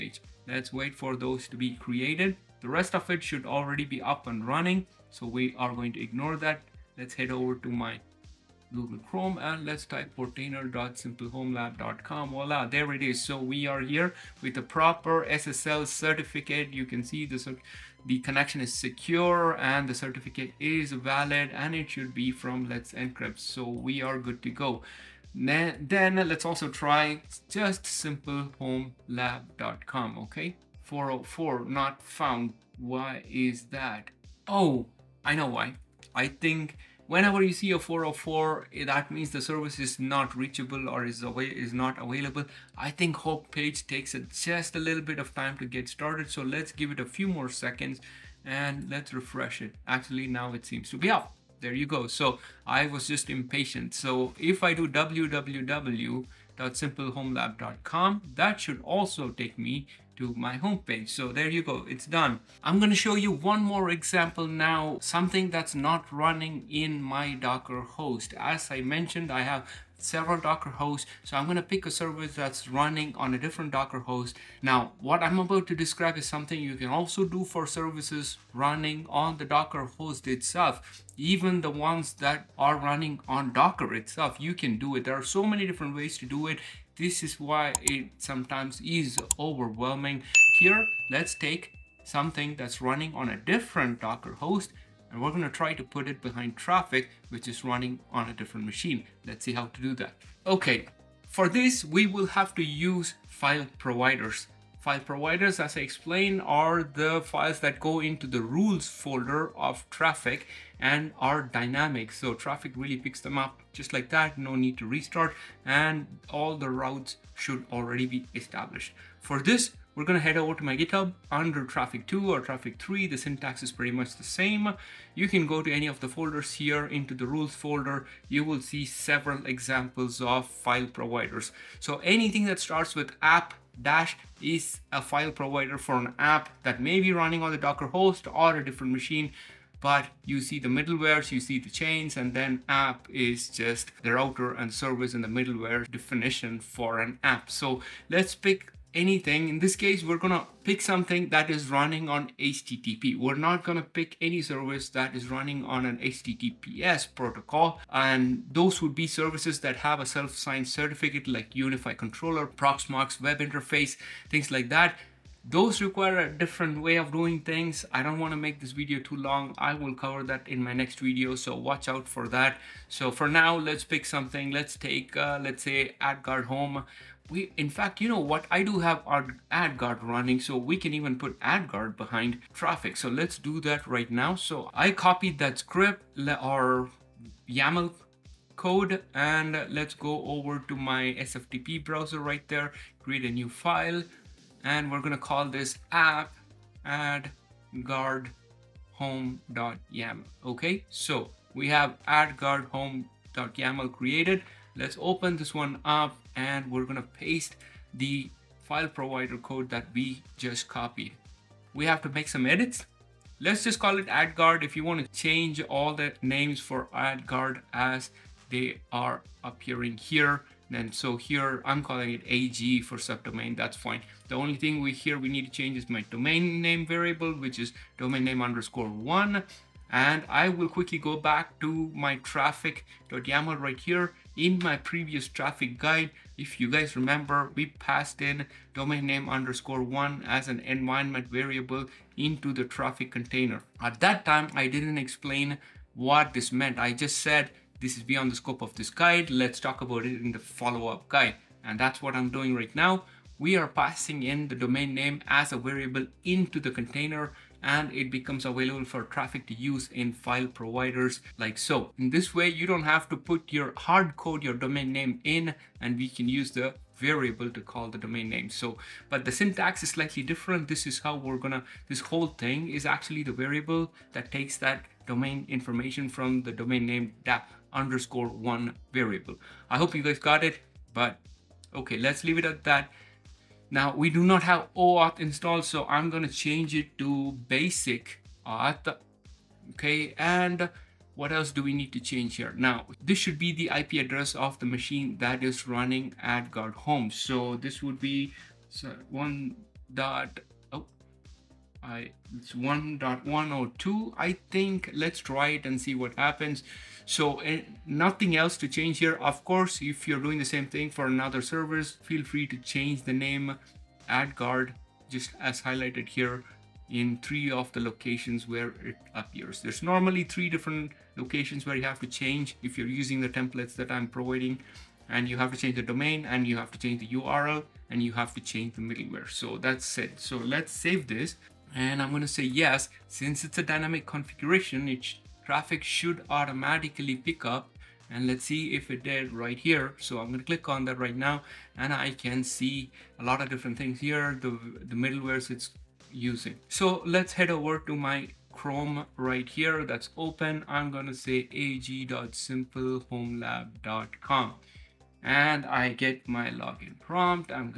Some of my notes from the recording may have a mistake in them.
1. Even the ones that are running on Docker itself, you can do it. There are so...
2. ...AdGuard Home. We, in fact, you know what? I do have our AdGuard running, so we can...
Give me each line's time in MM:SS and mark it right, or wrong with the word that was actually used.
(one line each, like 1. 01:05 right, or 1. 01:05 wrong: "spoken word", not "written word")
1. 01:21 right
2. 02:56 right.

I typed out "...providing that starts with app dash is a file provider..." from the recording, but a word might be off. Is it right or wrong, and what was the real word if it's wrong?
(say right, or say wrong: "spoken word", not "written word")
wrong: "anything", not "providing".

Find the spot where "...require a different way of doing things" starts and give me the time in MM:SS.
02:45.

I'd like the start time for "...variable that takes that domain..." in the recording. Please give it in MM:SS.
04:33.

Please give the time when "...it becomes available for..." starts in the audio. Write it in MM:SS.
04:17.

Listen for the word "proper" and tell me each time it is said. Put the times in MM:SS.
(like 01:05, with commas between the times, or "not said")
00:14.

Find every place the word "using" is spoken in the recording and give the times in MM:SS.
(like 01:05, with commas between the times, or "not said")
05:22, 05:46.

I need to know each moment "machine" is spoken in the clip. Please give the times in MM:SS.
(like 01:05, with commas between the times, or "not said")
01:38, 02:18, 04:54.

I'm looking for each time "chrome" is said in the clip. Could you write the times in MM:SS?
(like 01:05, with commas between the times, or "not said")
00:09, 05:48.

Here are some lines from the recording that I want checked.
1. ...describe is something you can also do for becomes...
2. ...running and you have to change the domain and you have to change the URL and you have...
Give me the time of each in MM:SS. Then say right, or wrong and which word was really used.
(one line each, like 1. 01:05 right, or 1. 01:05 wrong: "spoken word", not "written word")
1. 01:15 wrong: "services", not "becomes"
2. 05:24 wrong: "providing", not "running".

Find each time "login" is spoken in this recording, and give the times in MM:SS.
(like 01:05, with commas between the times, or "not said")
05:56.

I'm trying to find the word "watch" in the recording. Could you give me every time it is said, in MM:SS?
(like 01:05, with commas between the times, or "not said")
02:51.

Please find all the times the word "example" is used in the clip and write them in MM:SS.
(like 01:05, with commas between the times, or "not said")
01:03, 02:09.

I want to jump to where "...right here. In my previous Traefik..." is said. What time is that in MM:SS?
03:53.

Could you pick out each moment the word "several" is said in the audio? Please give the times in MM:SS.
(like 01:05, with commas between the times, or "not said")
01:10, 02:08.